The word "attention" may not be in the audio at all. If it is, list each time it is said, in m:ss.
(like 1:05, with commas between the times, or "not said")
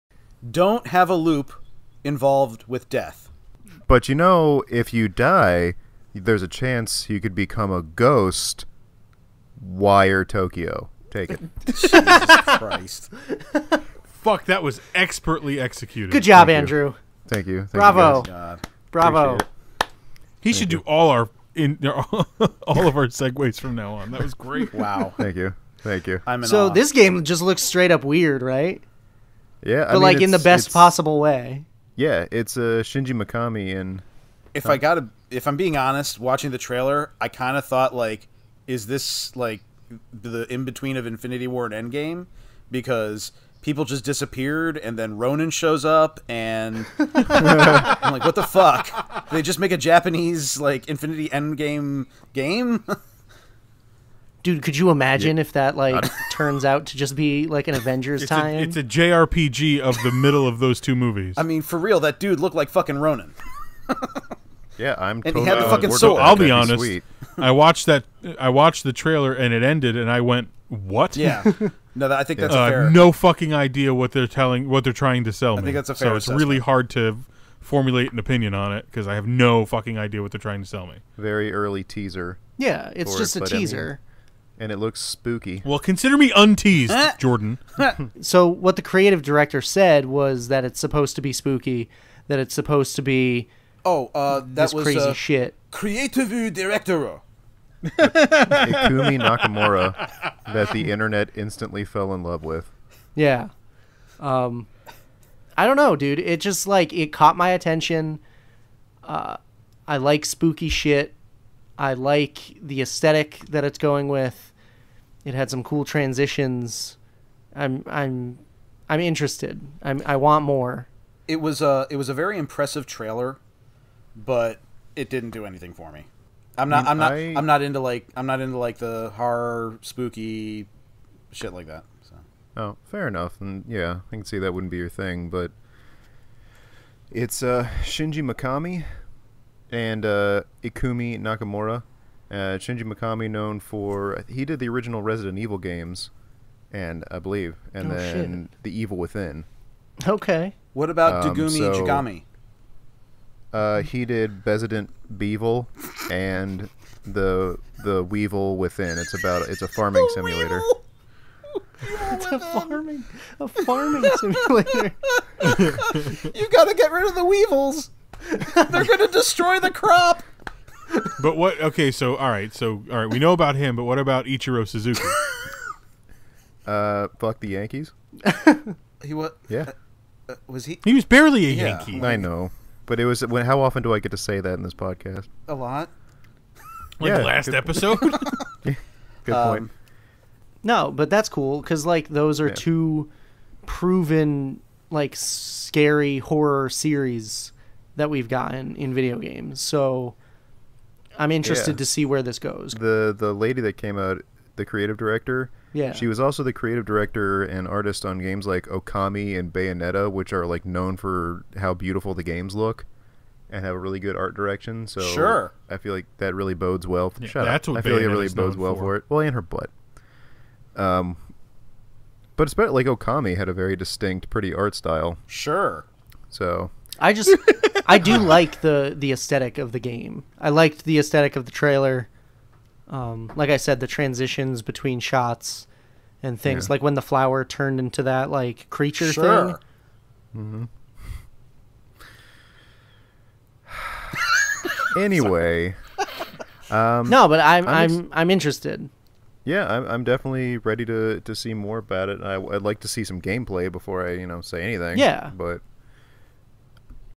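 1:47.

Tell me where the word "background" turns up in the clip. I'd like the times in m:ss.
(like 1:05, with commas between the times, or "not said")
not said.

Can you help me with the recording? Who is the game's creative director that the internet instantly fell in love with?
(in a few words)
Ikumi Nakamura.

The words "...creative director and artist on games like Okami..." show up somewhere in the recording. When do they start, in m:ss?
3:26.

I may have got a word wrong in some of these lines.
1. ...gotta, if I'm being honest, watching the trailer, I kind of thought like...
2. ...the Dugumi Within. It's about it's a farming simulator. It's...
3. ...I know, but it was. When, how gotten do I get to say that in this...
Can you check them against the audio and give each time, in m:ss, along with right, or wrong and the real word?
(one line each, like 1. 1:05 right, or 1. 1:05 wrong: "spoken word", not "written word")
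1. 0:34 right
2. 2:37 wrong: "Weevil", not "Dugumi"
3. 3:02 wrong: "often", not "gotten".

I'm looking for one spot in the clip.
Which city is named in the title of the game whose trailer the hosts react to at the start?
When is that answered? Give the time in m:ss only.
0:10.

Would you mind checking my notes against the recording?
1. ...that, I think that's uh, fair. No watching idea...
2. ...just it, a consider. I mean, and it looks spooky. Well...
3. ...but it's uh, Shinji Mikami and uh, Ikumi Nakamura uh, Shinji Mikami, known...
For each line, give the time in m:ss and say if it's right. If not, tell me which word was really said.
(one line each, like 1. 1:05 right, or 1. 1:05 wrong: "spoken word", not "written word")
1. 1:12 wrong: "fucking", not "watching"
2. 1:23 wrong: "teaser", not "consider"
3. 2:15 right.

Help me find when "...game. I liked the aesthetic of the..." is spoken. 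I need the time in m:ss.
3:49.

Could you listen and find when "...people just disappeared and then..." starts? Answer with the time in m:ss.
0:43.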